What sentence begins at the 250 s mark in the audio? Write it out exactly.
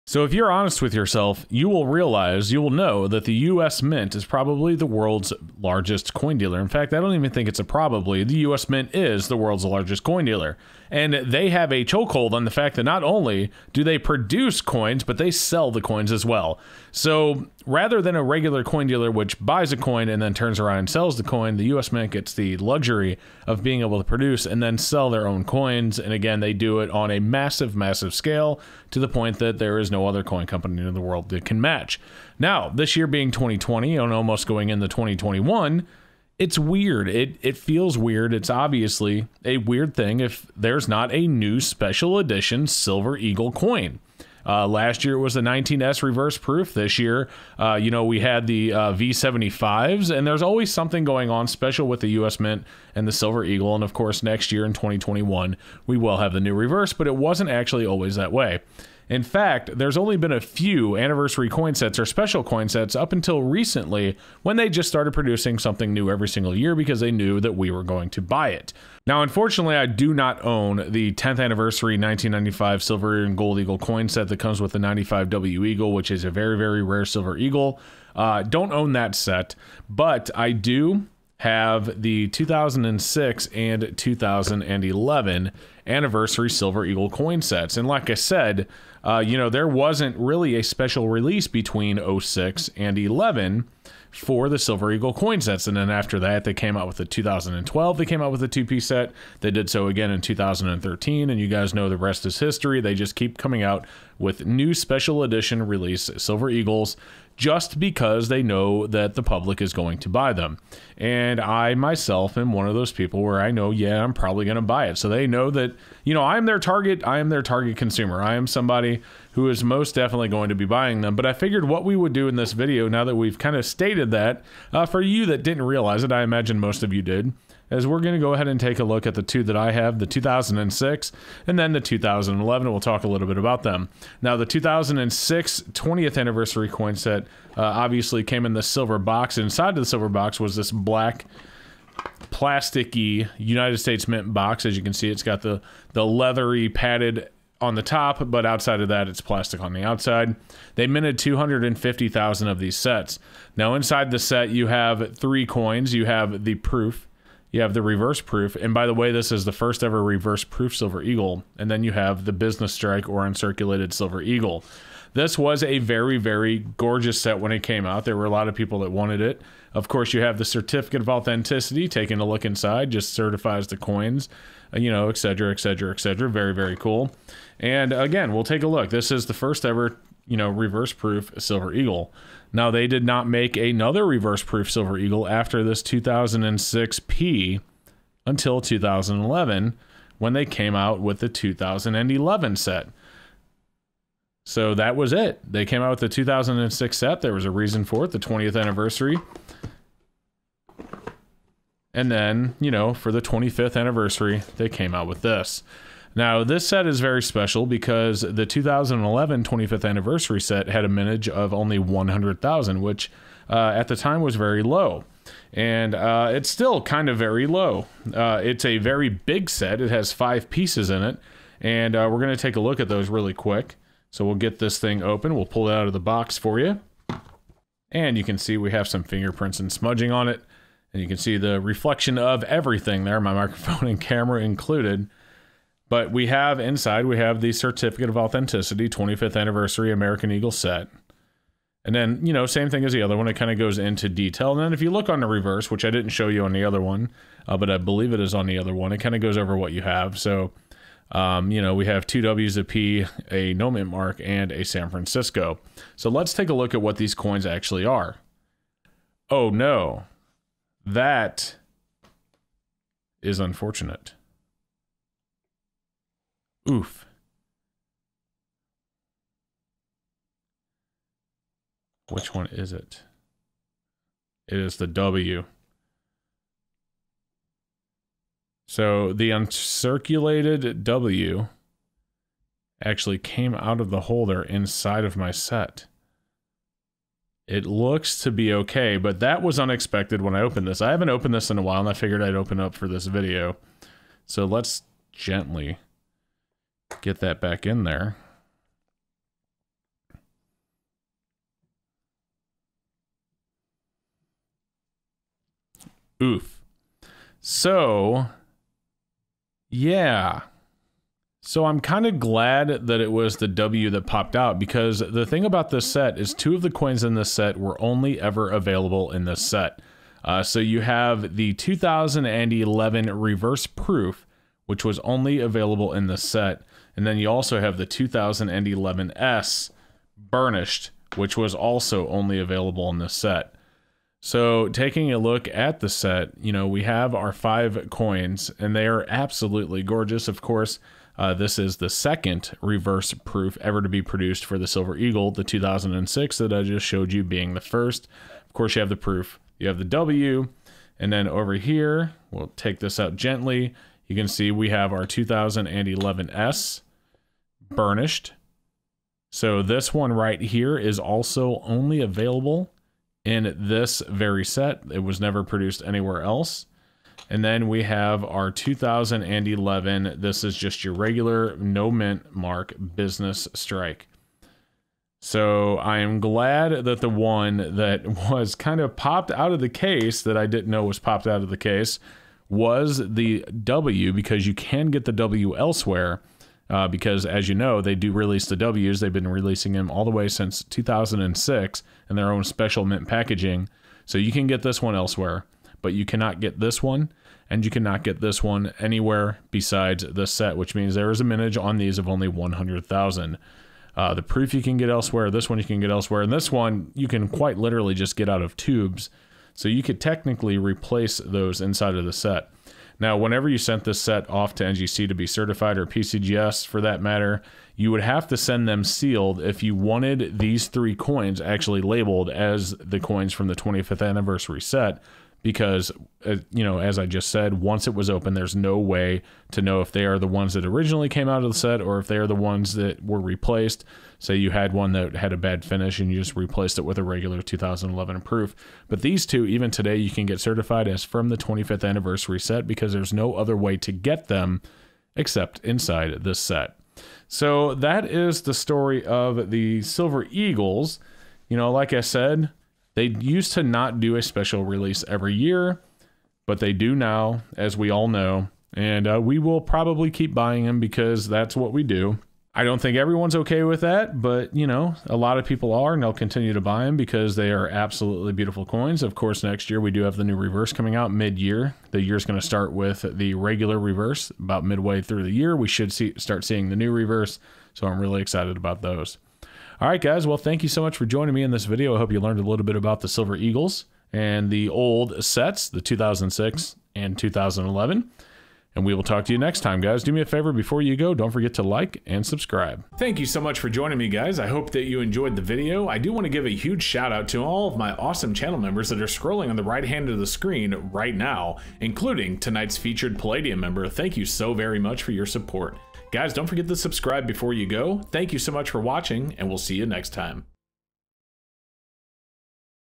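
So, um, you know, we have two W's, a P, a no mint mark, and a San Francisco.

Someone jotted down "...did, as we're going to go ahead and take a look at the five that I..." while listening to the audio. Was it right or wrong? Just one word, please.
wrong.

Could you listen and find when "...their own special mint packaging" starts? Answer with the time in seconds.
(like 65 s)
392 s.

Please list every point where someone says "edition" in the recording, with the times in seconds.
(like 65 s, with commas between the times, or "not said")
42 s, 105 s.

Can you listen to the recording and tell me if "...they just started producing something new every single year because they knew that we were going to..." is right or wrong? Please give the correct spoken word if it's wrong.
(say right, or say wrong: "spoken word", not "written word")
right.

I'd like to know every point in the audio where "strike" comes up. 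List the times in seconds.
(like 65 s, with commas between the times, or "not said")
162 s, 373 s.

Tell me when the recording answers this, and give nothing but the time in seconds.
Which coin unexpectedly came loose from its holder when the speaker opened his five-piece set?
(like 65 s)
279 s.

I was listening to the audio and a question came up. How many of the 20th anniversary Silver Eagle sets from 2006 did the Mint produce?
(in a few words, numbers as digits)
250,000.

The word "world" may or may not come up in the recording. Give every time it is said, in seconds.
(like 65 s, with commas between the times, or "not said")
4 s, 9 s, 30 s.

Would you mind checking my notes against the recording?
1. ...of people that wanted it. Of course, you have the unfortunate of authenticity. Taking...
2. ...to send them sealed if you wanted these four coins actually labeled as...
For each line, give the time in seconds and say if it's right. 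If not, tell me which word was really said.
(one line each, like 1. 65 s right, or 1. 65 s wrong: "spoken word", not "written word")
1. 168 s wrong: "certificate", not "unfortunate"
2. 418 s wrong: "three", not "four".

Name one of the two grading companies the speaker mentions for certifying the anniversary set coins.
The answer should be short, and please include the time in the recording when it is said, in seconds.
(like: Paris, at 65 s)
NGC, at 414 s.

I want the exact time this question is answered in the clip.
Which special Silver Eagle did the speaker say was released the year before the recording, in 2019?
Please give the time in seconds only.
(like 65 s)
45 s.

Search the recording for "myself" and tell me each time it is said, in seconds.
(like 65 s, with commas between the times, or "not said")
111 s.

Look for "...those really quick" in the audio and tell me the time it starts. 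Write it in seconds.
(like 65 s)
222 s.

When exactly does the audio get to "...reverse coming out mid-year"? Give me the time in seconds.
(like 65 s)
470 s.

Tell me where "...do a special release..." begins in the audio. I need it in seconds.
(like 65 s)
453 s.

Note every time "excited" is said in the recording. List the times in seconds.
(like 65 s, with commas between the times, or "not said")
478 s.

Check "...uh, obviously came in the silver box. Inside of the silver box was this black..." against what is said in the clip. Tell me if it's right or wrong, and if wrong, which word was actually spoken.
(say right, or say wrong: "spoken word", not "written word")
right.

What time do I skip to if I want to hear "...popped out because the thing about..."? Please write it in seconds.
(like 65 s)
314 s.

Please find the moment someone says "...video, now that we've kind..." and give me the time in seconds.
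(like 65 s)
122 s.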